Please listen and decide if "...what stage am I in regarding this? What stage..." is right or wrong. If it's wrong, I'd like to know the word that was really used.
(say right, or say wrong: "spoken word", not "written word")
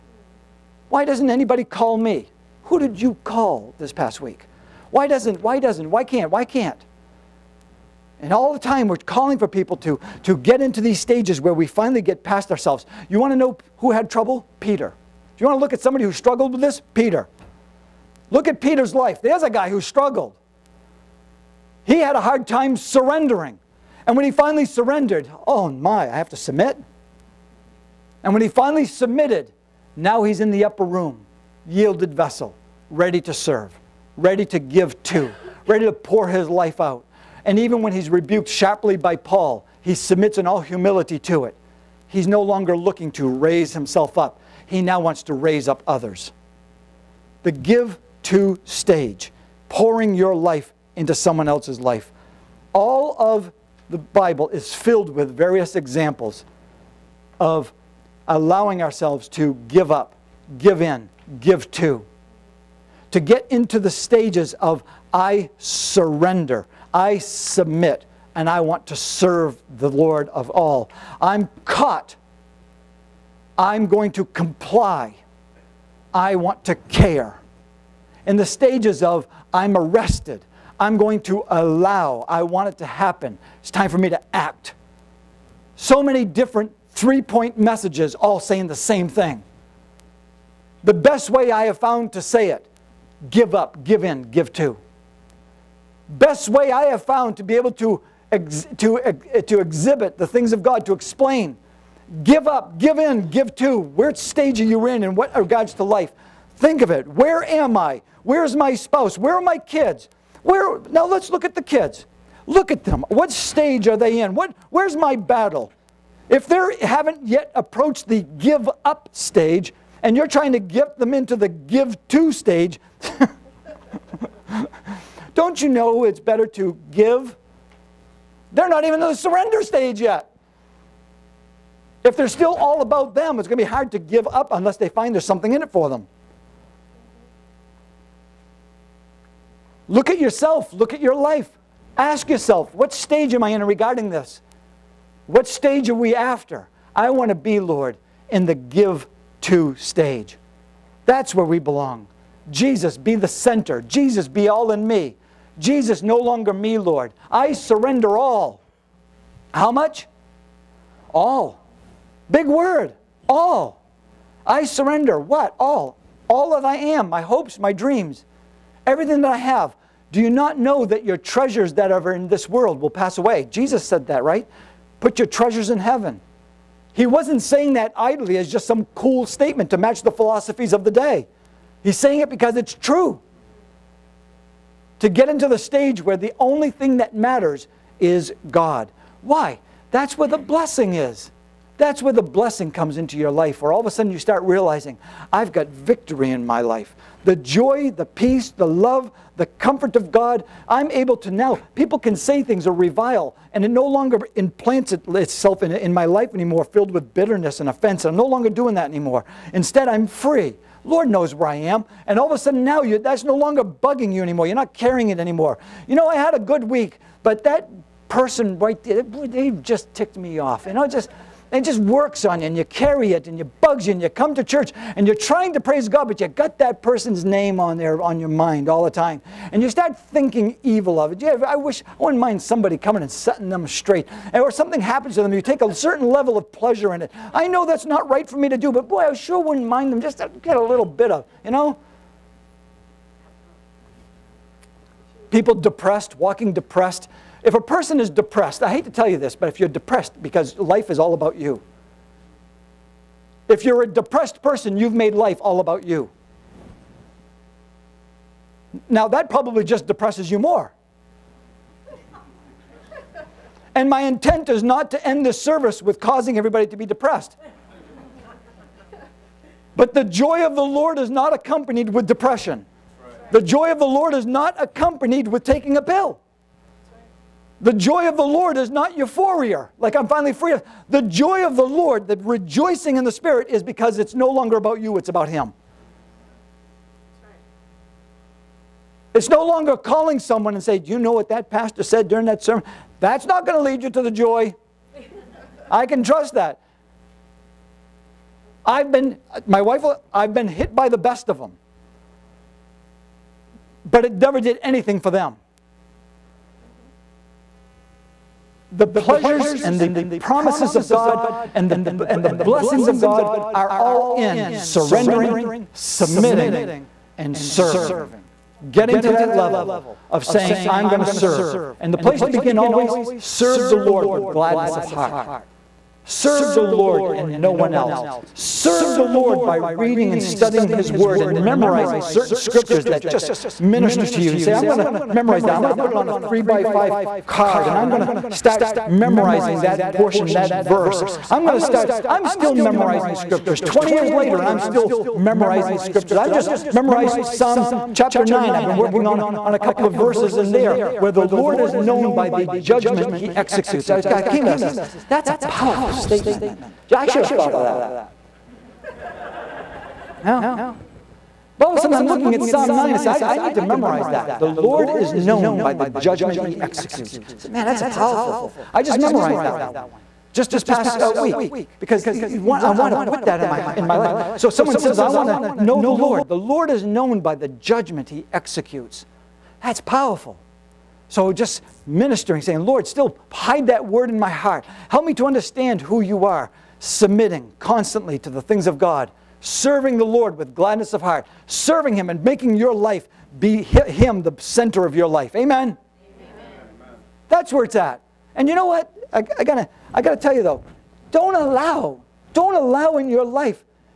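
right.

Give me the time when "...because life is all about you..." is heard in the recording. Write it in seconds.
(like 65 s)
250 s.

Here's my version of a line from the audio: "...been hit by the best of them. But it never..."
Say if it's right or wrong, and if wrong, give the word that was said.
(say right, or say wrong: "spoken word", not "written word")
right.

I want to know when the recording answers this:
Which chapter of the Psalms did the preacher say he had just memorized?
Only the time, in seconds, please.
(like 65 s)
347 s.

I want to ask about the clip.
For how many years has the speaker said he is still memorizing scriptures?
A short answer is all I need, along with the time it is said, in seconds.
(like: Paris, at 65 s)
20, at 343 s.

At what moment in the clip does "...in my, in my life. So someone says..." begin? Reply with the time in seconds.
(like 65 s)
373 s.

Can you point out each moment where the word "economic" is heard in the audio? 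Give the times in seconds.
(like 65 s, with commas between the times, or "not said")
not said.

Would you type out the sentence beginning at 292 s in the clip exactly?
That's not going to lead you to the joy.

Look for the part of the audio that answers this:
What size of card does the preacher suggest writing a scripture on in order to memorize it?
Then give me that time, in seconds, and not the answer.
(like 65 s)
336 s.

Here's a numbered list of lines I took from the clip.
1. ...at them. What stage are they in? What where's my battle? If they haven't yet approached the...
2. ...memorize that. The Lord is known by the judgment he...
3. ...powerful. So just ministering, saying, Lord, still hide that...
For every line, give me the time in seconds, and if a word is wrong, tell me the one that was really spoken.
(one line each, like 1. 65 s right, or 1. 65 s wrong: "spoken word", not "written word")
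1. 112 s right
2. 363 s right
3. 379 s right.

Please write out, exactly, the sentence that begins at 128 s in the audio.
They're not even in the surrender stage yet.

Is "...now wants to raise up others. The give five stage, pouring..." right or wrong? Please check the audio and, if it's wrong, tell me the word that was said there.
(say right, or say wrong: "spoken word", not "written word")
wrong: "two", not "five".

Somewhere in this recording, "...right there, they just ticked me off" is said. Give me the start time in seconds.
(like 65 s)
218 s.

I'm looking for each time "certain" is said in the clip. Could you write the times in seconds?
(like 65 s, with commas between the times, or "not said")
235 s, 332 s.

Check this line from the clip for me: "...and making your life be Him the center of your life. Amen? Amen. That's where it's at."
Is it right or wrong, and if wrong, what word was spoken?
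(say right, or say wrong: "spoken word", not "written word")
right.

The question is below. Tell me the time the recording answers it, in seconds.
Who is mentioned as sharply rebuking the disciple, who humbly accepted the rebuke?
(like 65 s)
39 s.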